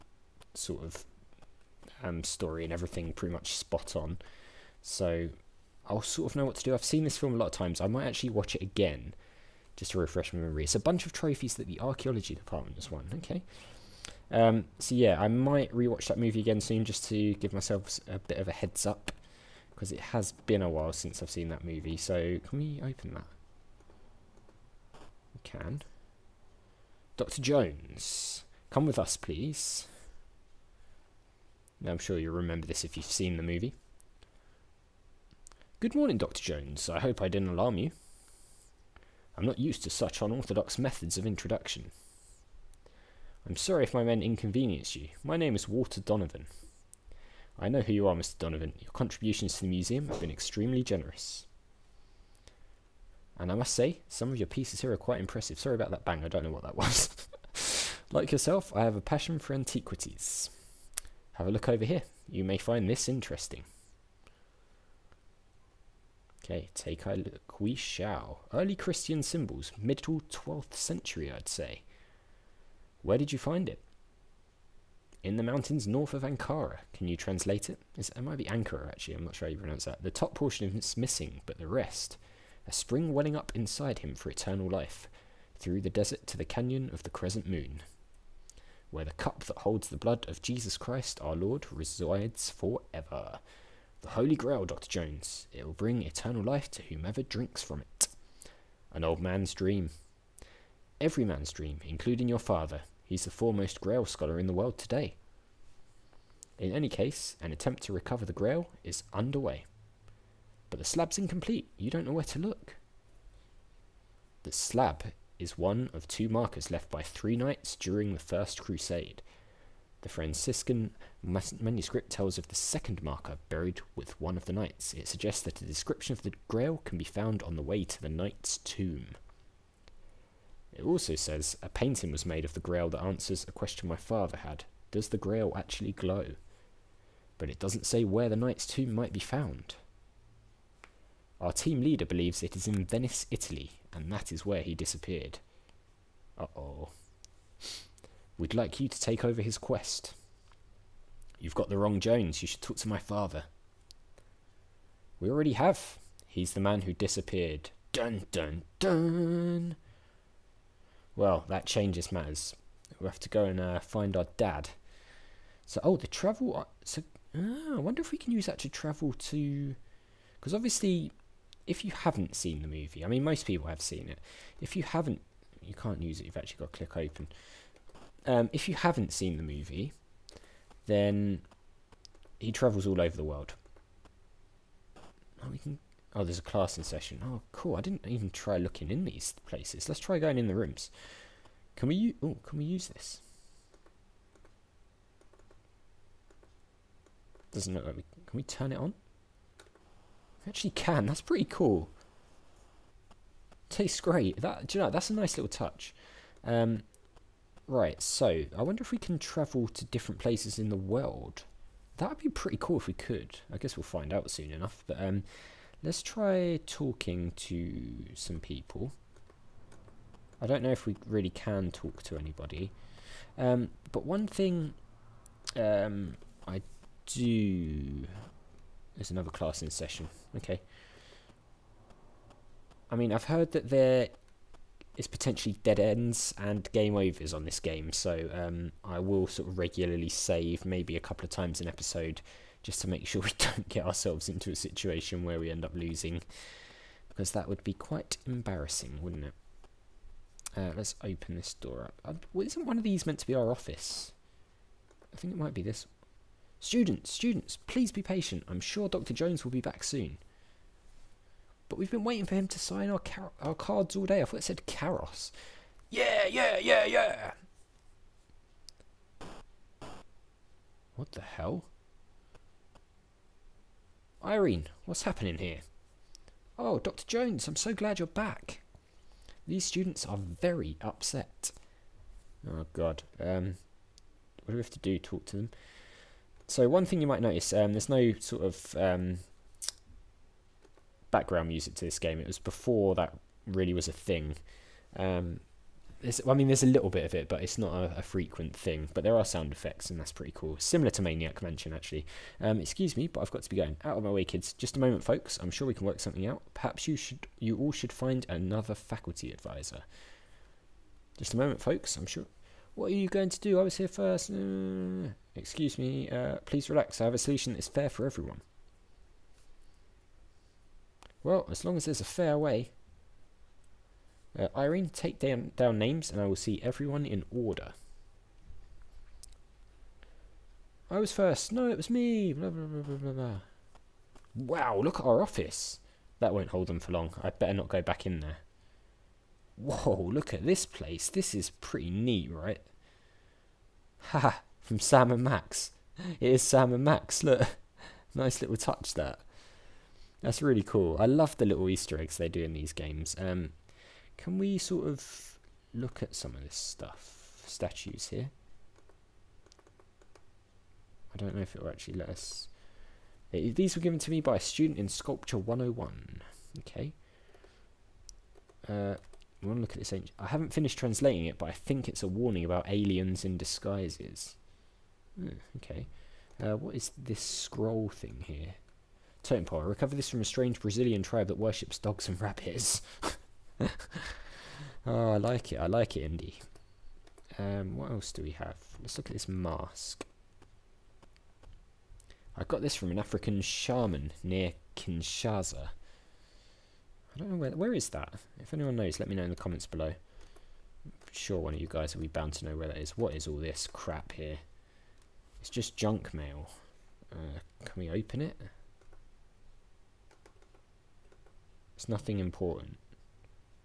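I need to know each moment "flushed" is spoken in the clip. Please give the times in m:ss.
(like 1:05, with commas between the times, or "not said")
not said.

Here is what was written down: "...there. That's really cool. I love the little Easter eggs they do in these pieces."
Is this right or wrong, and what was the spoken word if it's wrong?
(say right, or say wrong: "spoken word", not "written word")
wrong: "games", not "pieces".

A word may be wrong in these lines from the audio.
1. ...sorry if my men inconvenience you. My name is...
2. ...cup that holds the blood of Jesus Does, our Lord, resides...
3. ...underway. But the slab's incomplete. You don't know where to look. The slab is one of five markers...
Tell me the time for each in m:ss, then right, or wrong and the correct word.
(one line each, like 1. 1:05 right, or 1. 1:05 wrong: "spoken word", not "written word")
1. 0:43 right
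2. 1:29 wrong: "Christ", not "Does"
3. 1:49 wrong: "two", not "five".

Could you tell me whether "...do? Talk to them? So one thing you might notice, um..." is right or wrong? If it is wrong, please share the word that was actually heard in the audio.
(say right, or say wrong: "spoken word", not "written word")
right.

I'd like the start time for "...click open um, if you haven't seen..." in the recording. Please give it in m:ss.
2:56.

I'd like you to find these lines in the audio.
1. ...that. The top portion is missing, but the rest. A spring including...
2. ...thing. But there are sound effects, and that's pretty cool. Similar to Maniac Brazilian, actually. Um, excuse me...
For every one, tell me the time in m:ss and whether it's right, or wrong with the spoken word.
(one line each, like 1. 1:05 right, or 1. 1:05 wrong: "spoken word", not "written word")
1. 1:19 wrong: "welling", not "including"
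2. 4:58 wrong: "Mansion", not "Brazilian".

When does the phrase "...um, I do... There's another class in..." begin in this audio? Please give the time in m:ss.
3:45.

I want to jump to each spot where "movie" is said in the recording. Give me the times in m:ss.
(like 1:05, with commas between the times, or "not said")
0:16, 0:21, 0:33, 2:52, 2:59.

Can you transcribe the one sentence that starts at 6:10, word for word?
I haven't finished translating it, but I think it's a warning about aliens in disguises.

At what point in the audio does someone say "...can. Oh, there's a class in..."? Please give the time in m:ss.
3:05.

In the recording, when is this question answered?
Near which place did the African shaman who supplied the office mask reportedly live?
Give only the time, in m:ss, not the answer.
6:34.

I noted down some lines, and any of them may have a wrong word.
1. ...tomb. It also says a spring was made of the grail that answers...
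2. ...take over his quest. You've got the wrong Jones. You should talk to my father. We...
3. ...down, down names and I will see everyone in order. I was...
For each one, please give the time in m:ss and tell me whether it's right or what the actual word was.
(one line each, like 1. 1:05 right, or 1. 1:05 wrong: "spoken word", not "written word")
1. 2:08 wrong: "painting", not "spring"
2. 2:29 right
3. 5:25 right.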